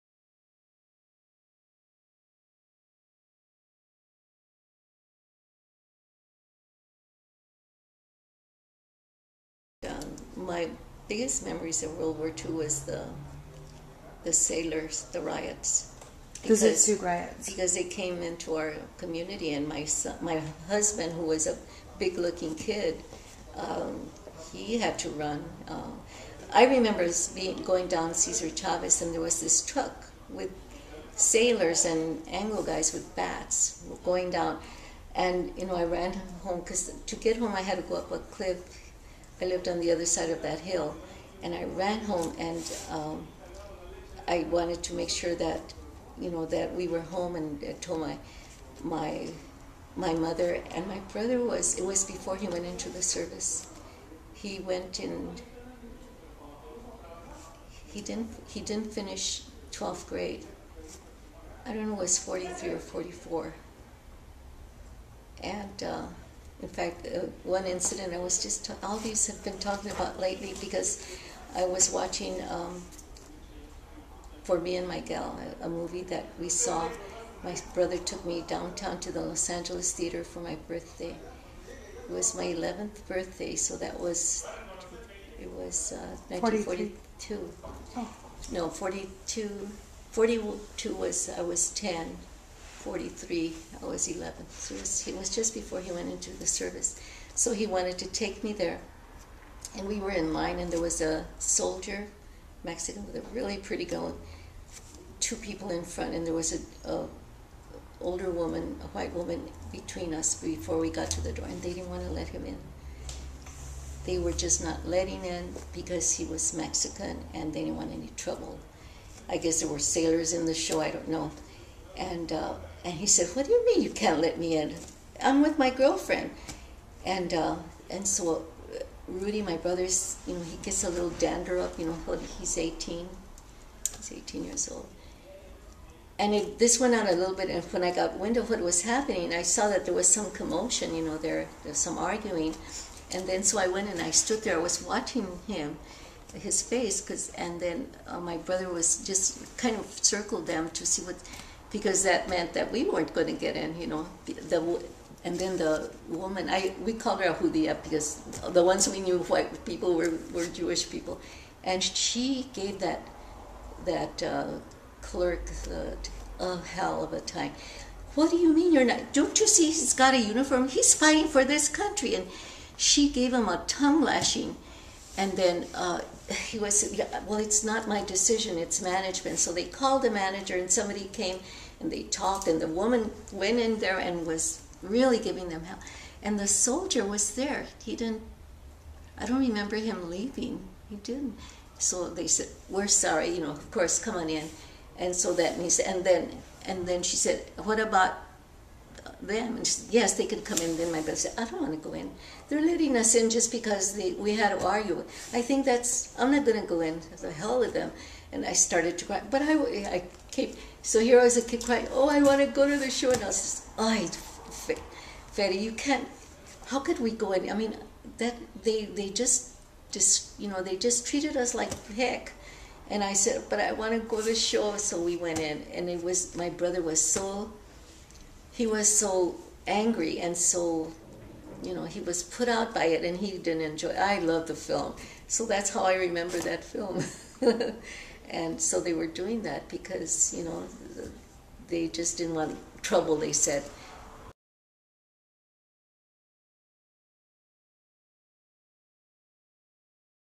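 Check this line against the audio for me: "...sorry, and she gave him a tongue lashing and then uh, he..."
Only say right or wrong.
wrong.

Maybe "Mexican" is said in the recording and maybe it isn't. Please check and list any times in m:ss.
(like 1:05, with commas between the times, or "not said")
1:42, 1:56.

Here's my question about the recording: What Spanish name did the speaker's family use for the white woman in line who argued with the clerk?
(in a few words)
Judía.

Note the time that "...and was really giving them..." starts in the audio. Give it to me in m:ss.
3:03.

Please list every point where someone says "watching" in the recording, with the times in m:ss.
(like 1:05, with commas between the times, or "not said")
1:11, 2:24.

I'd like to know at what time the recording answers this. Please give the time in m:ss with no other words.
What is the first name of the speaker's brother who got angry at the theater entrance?
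2:09.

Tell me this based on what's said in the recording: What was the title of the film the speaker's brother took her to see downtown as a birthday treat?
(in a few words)
For Me and My Gal.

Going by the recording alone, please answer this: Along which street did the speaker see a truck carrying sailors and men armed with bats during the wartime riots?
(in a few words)
Cesar Chavez.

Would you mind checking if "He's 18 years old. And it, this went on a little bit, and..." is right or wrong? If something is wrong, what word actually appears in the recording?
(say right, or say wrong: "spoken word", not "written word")
right.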